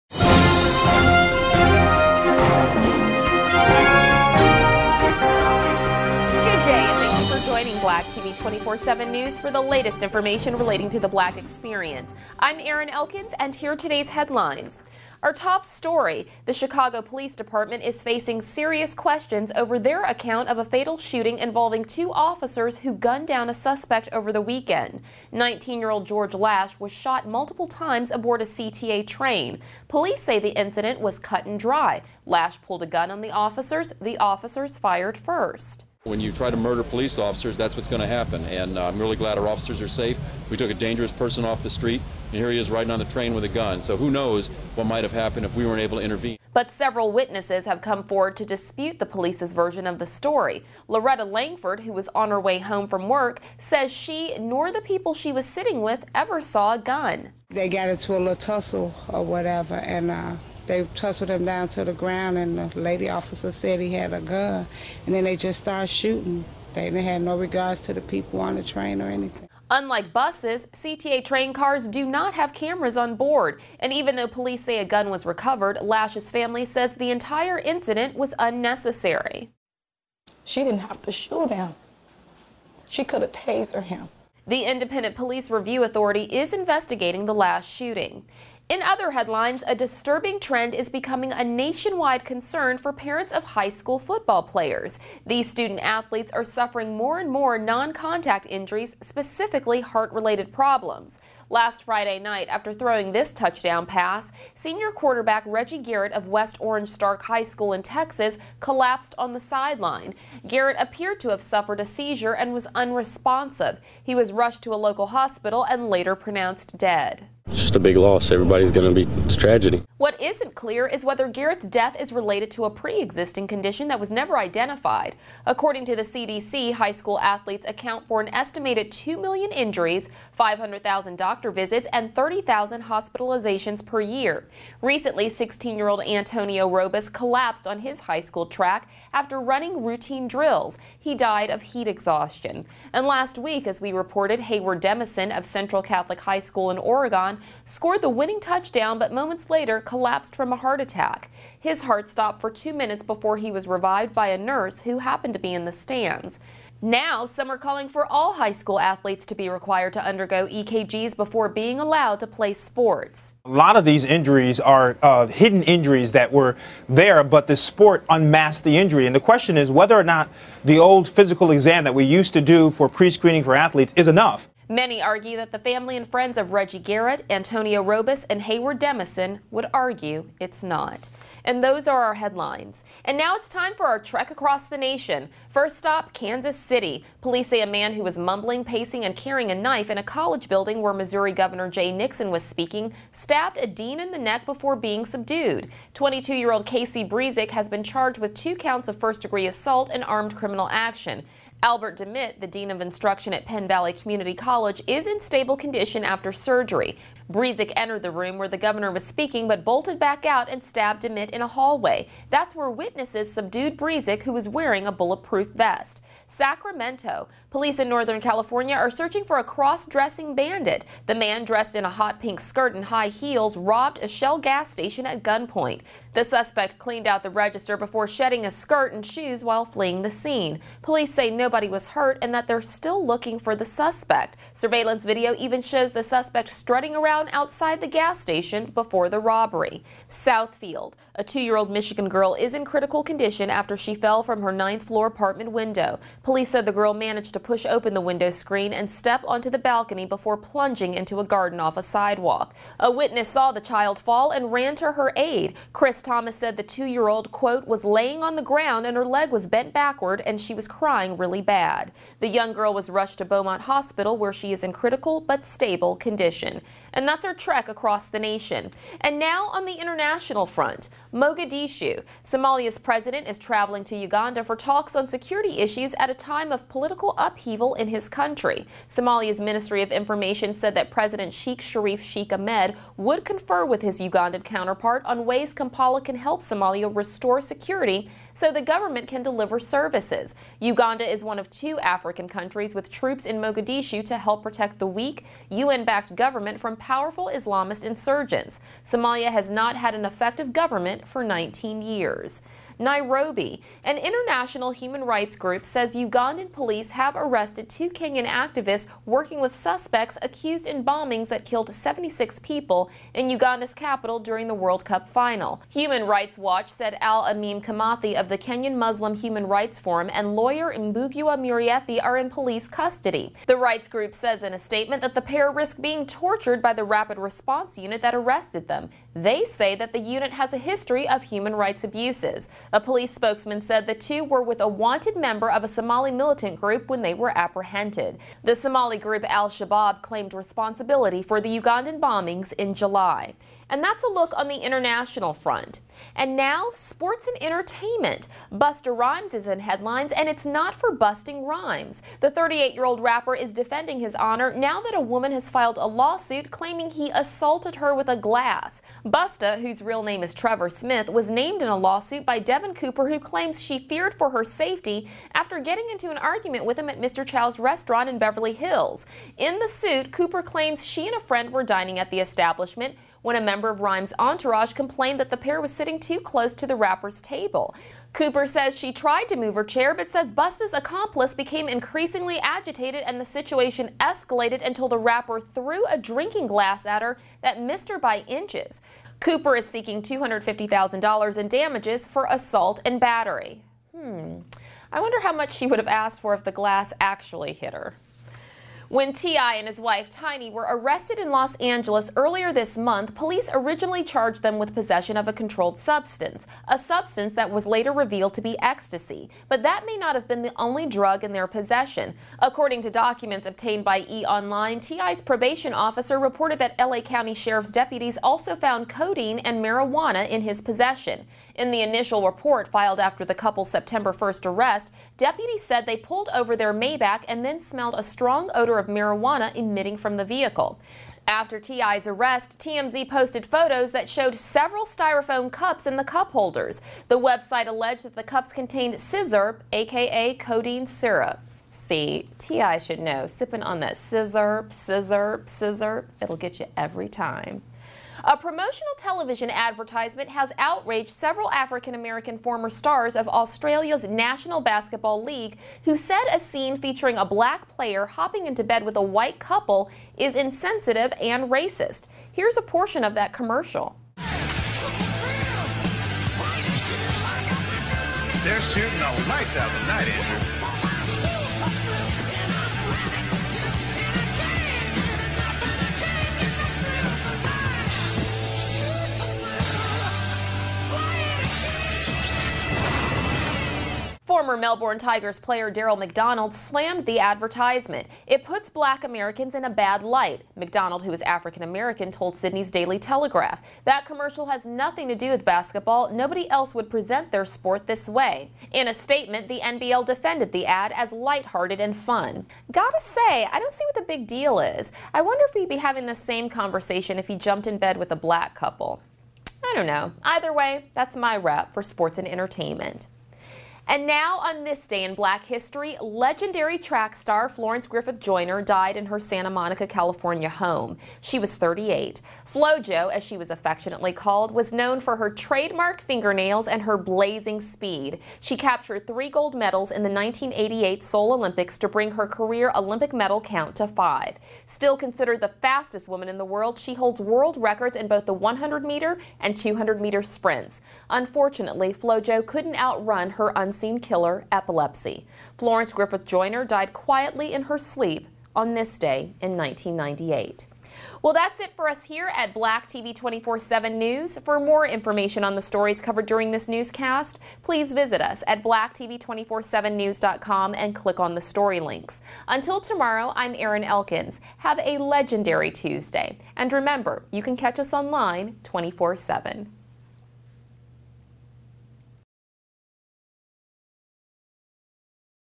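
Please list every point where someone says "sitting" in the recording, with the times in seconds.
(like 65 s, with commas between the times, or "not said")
55 s, 375 s.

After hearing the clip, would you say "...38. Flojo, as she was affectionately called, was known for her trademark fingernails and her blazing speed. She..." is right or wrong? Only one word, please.
right.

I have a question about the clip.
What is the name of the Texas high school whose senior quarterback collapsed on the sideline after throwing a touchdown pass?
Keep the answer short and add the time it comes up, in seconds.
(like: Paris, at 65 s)
West Orange Stark High School, at 106 s.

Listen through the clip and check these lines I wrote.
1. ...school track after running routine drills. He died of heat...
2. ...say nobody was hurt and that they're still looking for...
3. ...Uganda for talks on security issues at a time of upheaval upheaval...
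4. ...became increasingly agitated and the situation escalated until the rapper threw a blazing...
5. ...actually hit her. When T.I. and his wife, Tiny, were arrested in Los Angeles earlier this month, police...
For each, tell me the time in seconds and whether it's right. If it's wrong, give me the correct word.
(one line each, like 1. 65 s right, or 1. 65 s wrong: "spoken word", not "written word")
1. 138 s right
2. 231 s right
3. 273 s wrong: "political", not "upheaval"
4. 381 s wrong: "drinking", not "blazing"
5. 396 s right.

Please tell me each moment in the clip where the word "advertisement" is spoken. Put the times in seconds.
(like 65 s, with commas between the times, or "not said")
449 s, 487 s.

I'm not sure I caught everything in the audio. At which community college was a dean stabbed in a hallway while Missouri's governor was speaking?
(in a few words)
Penn Valley Community College.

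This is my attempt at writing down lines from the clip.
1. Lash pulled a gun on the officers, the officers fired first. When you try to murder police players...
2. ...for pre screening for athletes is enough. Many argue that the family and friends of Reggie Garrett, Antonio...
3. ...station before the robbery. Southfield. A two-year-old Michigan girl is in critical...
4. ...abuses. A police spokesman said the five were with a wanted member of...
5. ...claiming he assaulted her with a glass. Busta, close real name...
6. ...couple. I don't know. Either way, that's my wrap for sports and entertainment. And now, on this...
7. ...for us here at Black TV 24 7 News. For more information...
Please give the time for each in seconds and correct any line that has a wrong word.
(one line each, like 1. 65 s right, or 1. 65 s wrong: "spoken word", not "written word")
1. 32 s wrong: "officers", not "players"
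2. 172 s right
3. 238 s right
4. 331 s wrong: "two", not "five"
5. 356 s wrong: "whose", not "close"
6. 508 s right
7. 551 s right.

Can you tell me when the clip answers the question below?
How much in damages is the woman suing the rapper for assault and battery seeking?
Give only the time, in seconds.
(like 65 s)
390 s.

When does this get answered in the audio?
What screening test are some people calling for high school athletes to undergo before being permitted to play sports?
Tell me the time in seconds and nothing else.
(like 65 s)
160 s.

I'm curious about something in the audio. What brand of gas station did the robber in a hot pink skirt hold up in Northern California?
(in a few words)
Shell.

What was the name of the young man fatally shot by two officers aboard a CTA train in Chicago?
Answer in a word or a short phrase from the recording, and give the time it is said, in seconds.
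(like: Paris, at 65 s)
George Lash, at 26 s.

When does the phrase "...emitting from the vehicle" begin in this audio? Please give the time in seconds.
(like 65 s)
429 s.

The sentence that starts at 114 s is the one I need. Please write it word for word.
He was rushed to a local hospital and later pronounced dead.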